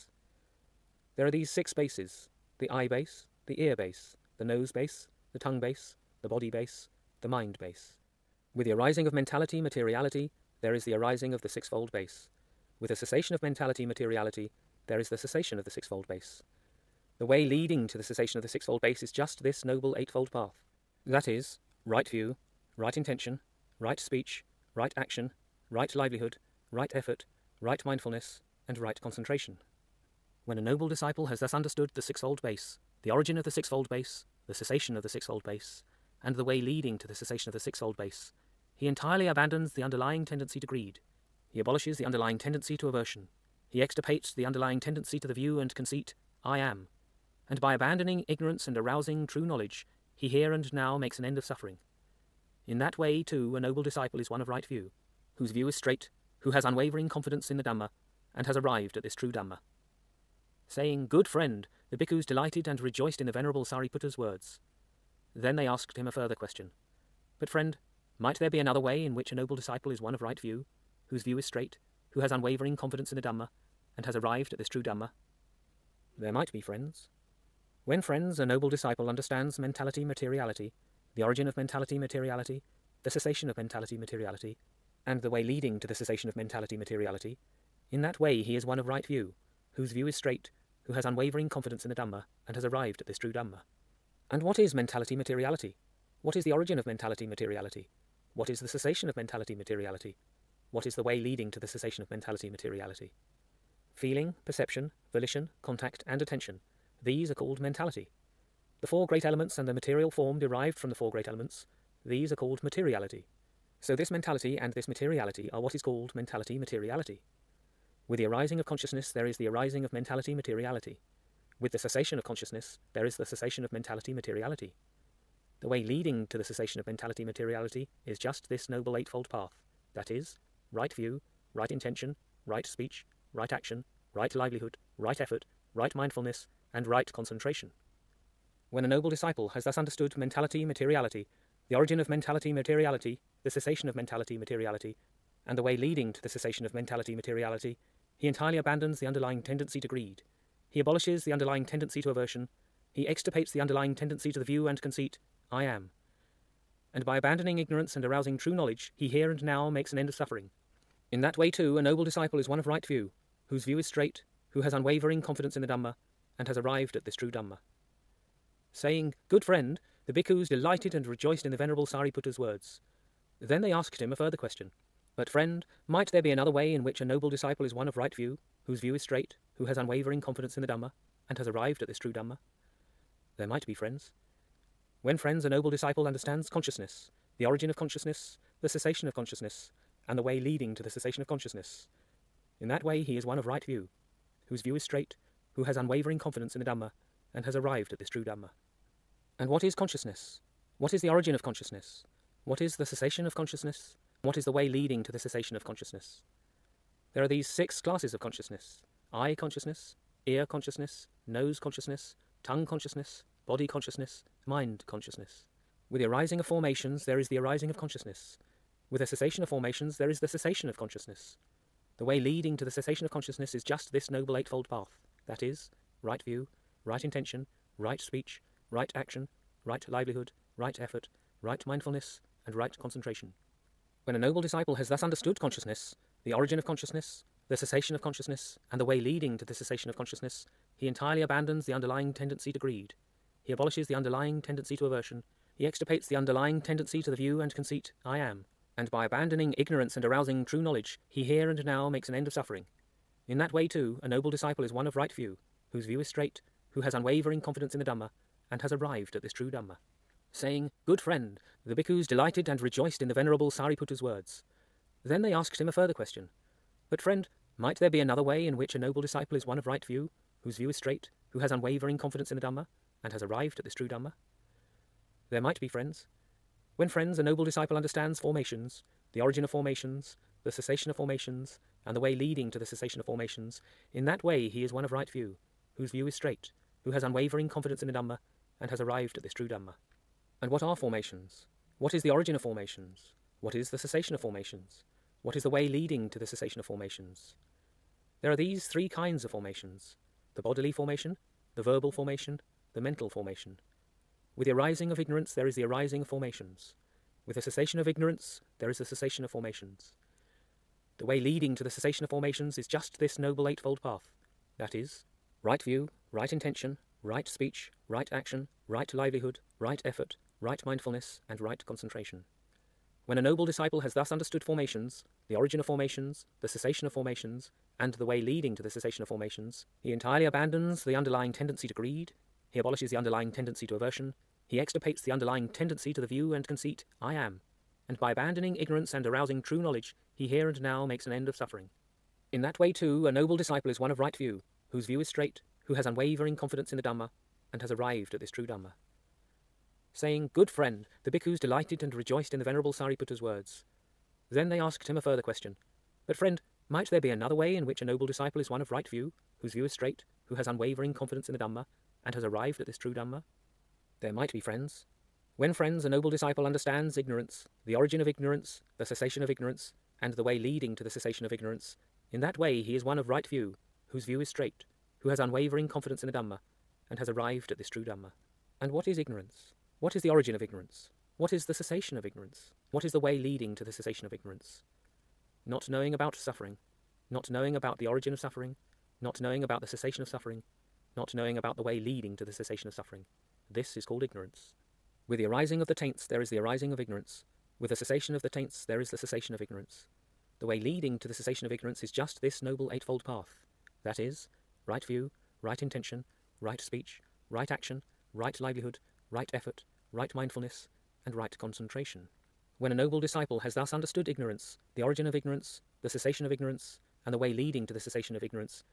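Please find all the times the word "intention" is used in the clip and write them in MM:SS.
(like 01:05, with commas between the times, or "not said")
00:22, 02:11, 03:47, 05:16, 06:45.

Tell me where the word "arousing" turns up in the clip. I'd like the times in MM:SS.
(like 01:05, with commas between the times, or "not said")
00:48, 02:38, 04:10, 05:39.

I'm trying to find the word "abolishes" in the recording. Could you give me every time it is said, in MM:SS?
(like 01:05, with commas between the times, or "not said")
00:41, 02:30, 04:03, 05:32.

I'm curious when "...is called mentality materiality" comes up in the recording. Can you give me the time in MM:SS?
01:55.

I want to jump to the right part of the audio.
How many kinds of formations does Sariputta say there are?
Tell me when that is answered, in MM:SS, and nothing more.
04:58.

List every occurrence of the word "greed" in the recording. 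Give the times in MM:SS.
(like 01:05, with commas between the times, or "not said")
00:40, 02:29, 04:02, 05:31.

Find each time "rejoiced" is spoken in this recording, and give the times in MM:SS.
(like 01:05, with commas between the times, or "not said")
01:02, 02:51, 04:22, 05:51.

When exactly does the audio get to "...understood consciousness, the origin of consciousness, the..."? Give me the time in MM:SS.
03:55.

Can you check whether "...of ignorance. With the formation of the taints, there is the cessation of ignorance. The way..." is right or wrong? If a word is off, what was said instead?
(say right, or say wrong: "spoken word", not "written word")
wrong: "cessation", not "formation".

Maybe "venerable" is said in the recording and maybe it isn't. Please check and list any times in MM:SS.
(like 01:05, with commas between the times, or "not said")
01:03, 02:51, 04:23, 05:52.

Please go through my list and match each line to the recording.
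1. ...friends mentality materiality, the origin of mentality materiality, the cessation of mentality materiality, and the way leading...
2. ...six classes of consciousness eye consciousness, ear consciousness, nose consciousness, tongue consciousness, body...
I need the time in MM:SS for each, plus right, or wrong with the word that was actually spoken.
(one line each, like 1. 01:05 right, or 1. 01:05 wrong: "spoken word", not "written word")
1. 01:19 wrong: "understands", not "friends"
2. 03:27 right.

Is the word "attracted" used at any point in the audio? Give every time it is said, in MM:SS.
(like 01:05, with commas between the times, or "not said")
not said.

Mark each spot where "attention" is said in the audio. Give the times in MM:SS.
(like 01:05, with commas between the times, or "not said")
01:46.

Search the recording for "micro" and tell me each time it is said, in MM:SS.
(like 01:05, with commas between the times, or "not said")
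not said.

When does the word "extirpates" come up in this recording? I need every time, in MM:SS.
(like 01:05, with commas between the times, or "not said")
00:43, 02:33, 04:05, 05:34.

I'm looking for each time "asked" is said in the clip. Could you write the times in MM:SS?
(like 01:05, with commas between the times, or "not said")
01:05, 02:53, 04:25, 05:54.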